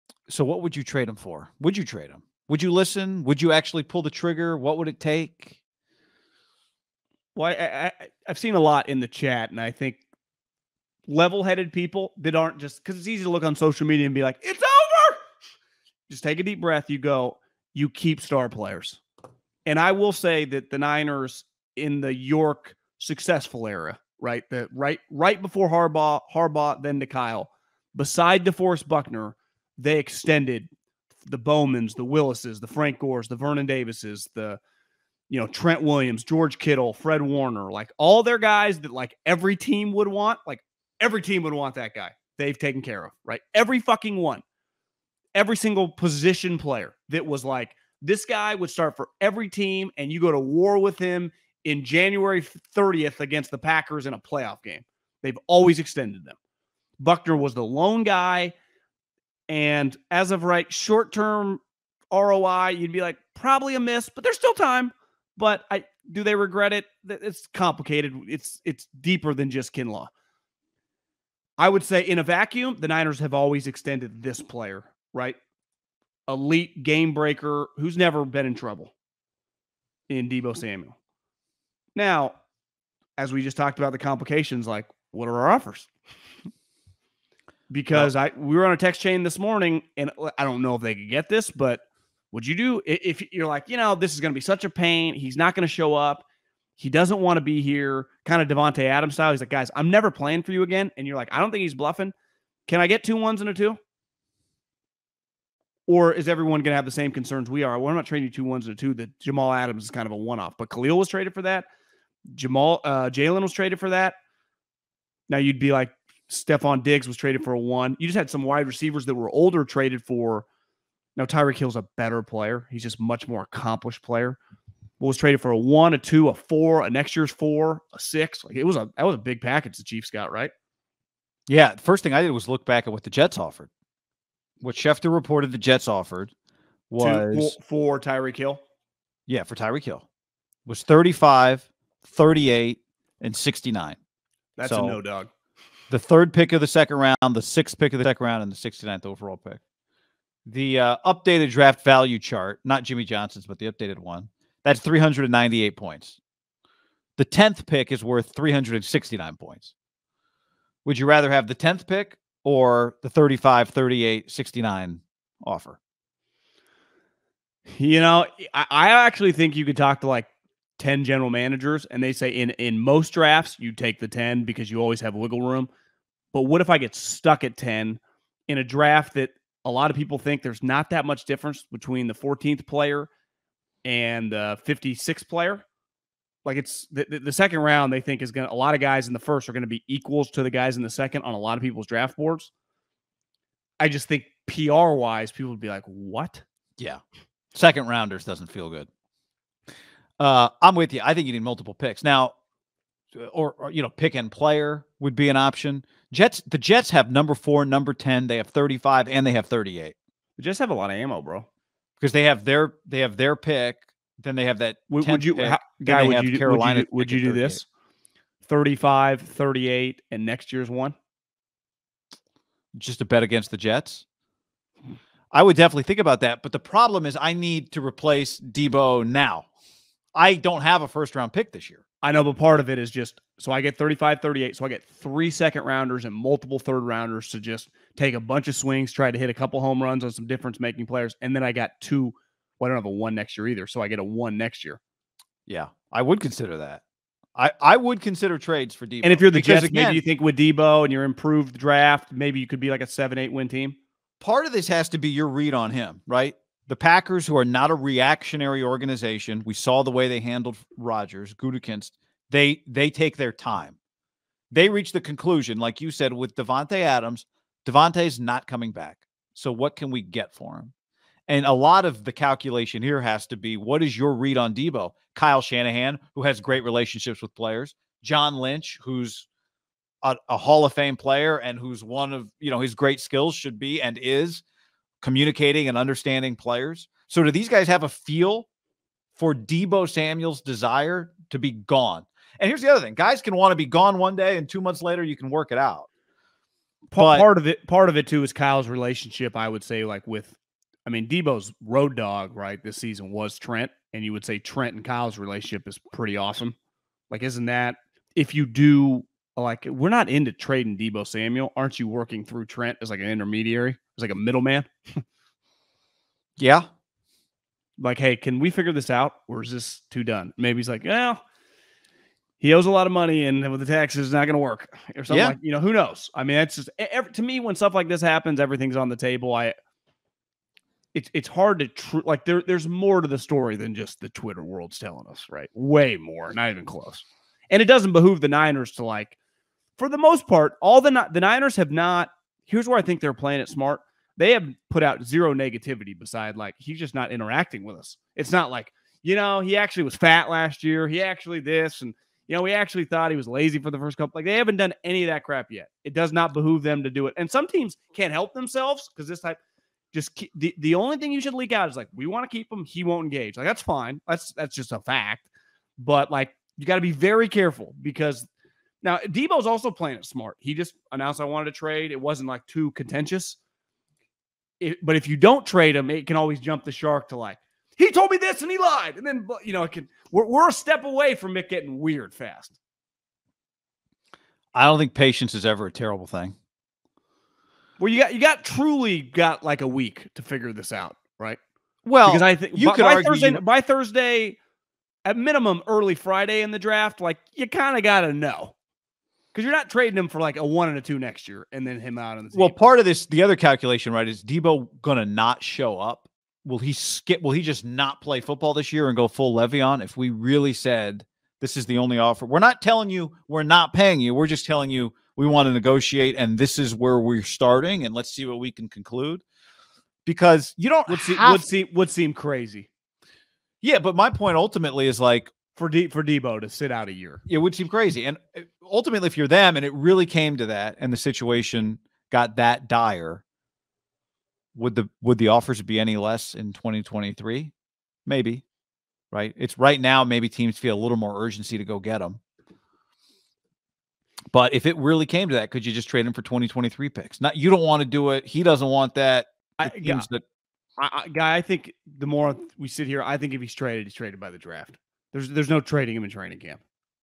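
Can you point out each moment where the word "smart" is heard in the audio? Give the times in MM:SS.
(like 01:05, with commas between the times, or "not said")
05:43, 06:10.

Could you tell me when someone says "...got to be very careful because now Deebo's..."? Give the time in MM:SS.
06:06.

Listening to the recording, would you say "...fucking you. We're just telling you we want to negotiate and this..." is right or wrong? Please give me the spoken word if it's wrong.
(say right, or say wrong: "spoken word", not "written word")
wrong: "paying", not "fucking".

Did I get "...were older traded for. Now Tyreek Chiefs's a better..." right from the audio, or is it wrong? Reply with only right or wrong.
wrong.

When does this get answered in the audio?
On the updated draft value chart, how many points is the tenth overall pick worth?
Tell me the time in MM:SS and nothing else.
02:38.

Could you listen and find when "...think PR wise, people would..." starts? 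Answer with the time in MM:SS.
03:14.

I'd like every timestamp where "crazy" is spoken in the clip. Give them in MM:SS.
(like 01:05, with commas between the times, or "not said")
07:02, 07:07.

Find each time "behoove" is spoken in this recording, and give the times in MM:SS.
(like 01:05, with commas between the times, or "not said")
05:37, 05:56.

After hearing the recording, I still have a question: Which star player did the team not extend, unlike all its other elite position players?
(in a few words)
DeForest Buckner.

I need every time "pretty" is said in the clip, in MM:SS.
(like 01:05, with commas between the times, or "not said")
05:05.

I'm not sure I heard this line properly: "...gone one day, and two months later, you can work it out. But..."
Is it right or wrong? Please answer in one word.
right.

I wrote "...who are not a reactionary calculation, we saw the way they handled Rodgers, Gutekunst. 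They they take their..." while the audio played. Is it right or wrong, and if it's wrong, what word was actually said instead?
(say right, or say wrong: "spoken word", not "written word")
wrong: "organization", not "calculation".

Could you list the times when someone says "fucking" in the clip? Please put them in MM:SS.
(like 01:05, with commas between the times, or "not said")
00:43.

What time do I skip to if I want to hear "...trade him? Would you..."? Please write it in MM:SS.
00:01.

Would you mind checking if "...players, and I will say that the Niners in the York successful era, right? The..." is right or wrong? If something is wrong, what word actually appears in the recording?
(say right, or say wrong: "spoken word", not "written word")
right.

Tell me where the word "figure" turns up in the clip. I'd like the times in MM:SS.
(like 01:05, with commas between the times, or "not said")
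05:18, 06:30.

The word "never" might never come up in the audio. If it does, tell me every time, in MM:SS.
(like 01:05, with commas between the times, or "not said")
01:17, 01:39.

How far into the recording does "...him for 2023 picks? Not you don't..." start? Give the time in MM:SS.
07:26.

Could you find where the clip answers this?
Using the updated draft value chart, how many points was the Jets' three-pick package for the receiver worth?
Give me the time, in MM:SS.
02:34.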